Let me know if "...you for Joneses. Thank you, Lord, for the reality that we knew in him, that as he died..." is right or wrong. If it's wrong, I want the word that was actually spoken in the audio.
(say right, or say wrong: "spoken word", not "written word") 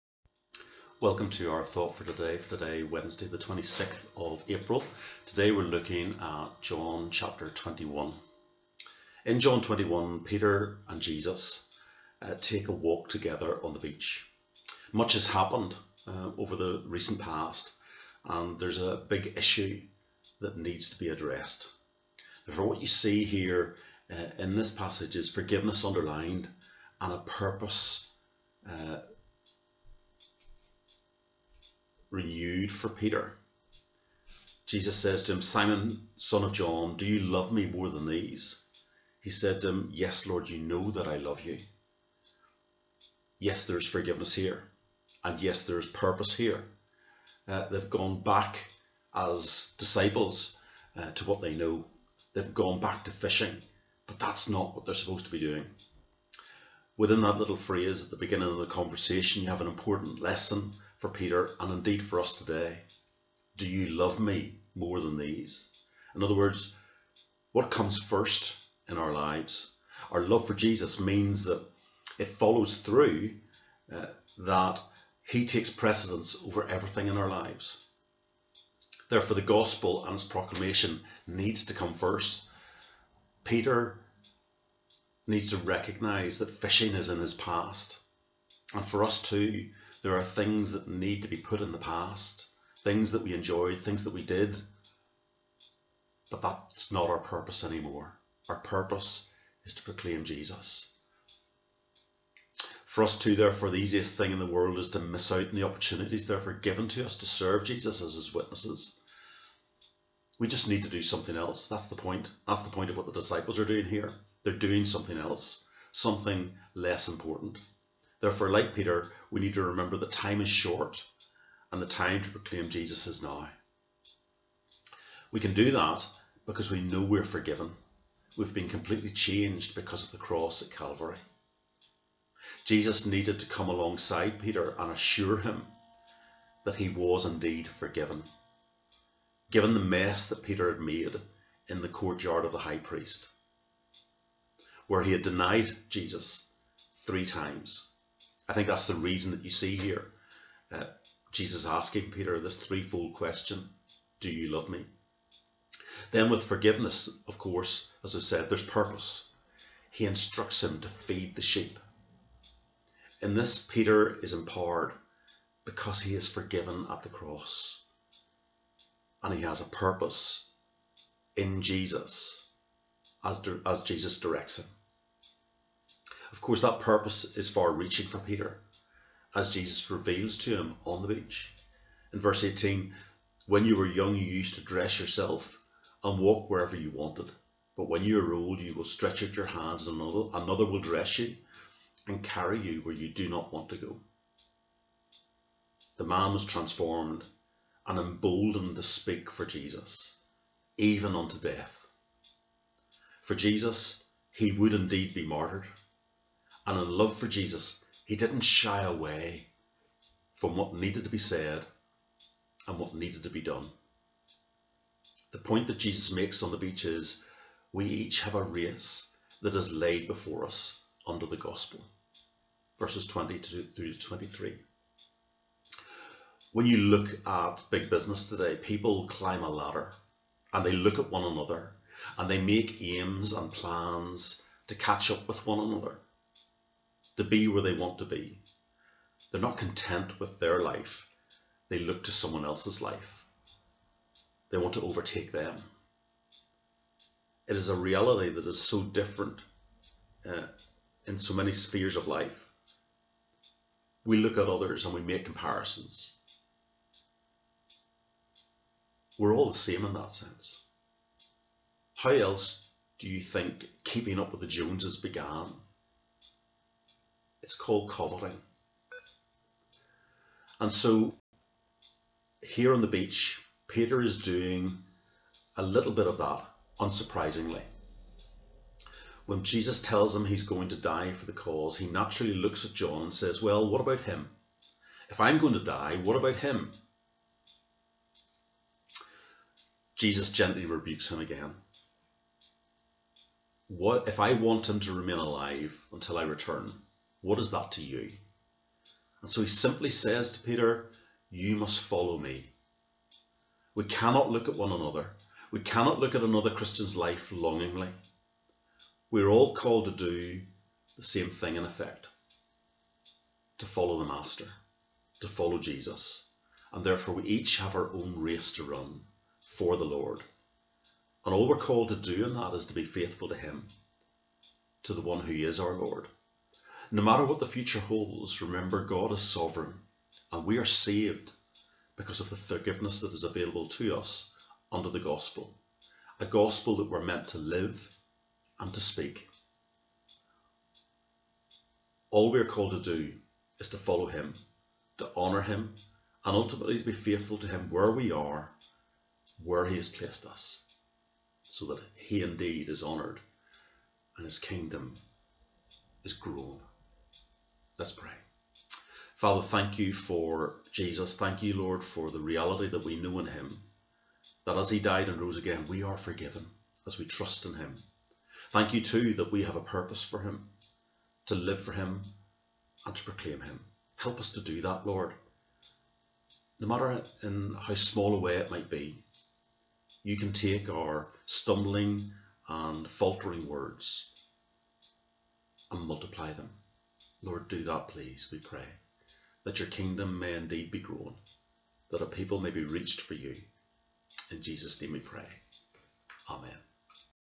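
wrong: "Jesus", not "Joneses".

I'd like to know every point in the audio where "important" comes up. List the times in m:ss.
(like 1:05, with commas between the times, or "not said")
0:59, 1:57.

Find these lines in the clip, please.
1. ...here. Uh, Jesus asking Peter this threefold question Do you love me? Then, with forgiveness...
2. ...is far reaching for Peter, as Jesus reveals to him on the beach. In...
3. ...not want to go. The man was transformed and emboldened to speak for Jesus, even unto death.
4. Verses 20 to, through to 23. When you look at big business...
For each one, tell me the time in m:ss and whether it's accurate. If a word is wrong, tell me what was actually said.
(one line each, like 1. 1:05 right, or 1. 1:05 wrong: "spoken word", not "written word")
1. 2:29 right
2. 2:57 right
3. 3:13 right
4. 3:42 right.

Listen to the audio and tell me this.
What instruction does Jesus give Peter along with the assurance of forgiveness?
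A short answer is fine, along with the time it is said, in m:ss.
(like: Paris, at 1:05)
Feed the sheep, at 2:40.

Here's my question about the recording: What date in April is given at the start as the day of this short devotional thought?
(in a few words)
26th.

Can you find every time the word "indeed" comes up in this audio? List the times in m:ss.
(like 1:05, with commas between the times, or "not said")
1:01, 2:17, 3:24, 5:52, 6:30.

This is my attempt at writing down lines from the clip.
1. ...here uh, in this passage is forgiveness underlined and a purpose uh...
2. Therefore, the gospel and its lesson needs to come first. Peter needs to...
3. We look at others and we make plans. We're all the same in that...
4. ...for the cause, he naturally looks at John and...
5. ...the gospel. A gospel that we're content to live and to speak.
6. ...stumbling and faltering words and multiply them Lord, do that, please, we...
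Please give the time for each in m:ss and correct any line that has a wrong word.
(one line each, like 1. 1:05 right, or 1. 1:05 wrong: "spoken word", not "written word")
1. 0:23 right
2. 1:19 wrong: "proclamation", not "lesson"
3. 4:14 wrong: "comparisons", not "plans"
4. 4:41 right
5. 5:34 wrong: "meant", not "content"
6. 6:21 right.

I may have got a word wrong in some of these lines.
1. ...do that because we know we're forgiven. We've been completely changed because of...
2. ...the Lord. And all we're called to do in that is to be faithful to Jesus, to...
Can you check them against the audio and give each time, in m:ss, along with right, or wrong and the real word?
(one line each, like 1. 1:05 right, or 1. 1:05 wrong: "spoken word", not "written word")
1. 2:05 right
2. 5:19 wrong: "Him", not "Jesus".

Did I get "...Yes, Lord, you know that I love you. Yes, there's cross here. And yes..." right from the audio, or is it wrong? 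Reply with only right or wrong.
wrong.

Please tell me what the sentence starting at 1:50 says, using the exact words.
We just need to do something else.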